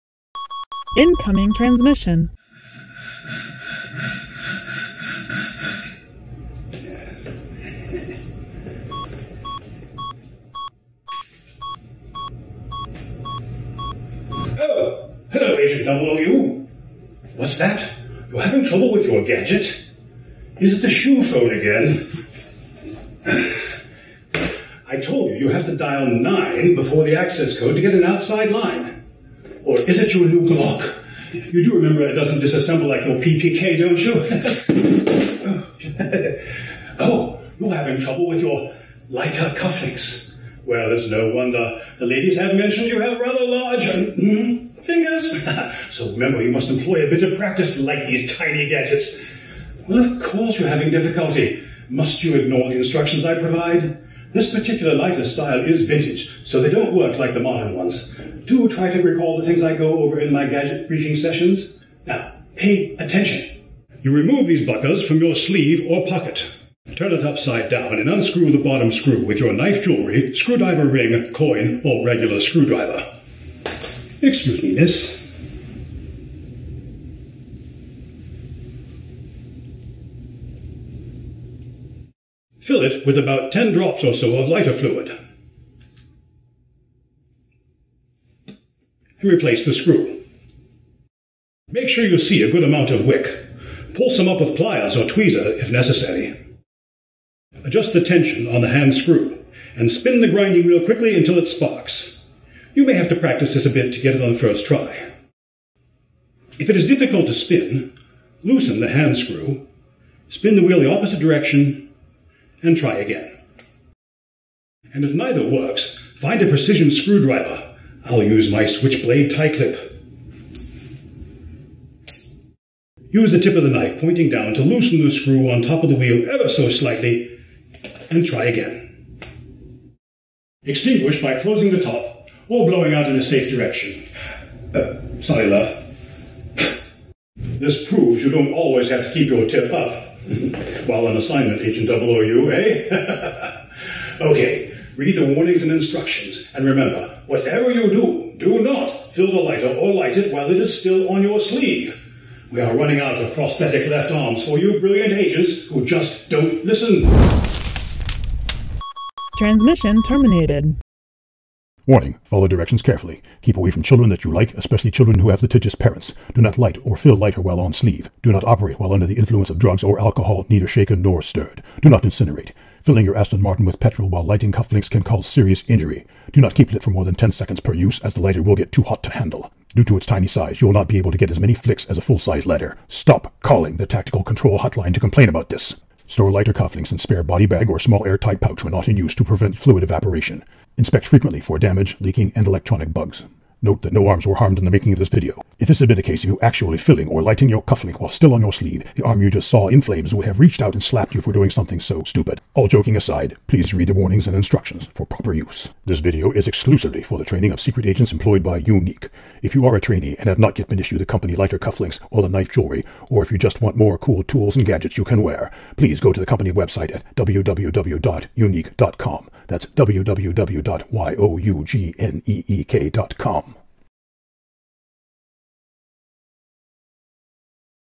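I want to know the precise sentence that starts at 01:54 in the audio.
And if neither works, find a precision screwdriver.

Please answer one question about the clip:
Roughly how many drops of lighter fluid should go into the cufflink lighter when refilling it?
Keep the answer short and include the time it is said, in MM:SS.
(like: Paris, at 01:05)
10, at 01:23.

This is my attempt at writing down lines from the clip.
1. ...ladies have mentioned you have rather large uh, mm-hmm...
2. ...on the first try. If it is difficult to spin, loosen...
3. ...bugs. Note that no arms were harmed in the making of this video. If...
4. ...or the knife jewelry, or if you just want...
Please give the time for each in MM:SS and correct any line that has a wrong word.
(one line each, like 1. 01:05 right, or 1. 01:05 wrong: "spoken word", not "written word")
1. 00:42 right
2. 01:44 right
3. 03:12 right
4. 03:32 right.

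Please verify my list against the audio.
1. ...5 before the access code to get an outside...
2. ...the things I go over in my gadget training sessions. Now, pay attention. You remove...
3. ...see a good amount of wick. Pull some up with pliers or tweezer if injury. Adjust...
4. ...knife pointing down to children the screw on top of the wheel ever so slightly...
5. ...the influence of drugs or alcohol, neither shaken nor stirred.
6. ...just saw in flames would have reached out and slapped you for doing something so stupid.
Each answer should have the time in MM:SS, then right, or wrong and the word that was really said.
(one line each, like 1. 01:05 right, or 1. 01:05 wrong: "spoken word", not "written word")
1. 00:26 wrong: "9", not "5"
2. 00:59 wrong: "briefing", not "training"
3. 01:32 wrong: "necessary", not "injury"
4. 02:03 wrong: "loosen", not "children"
5. 02:49 right
6. 03:19 right.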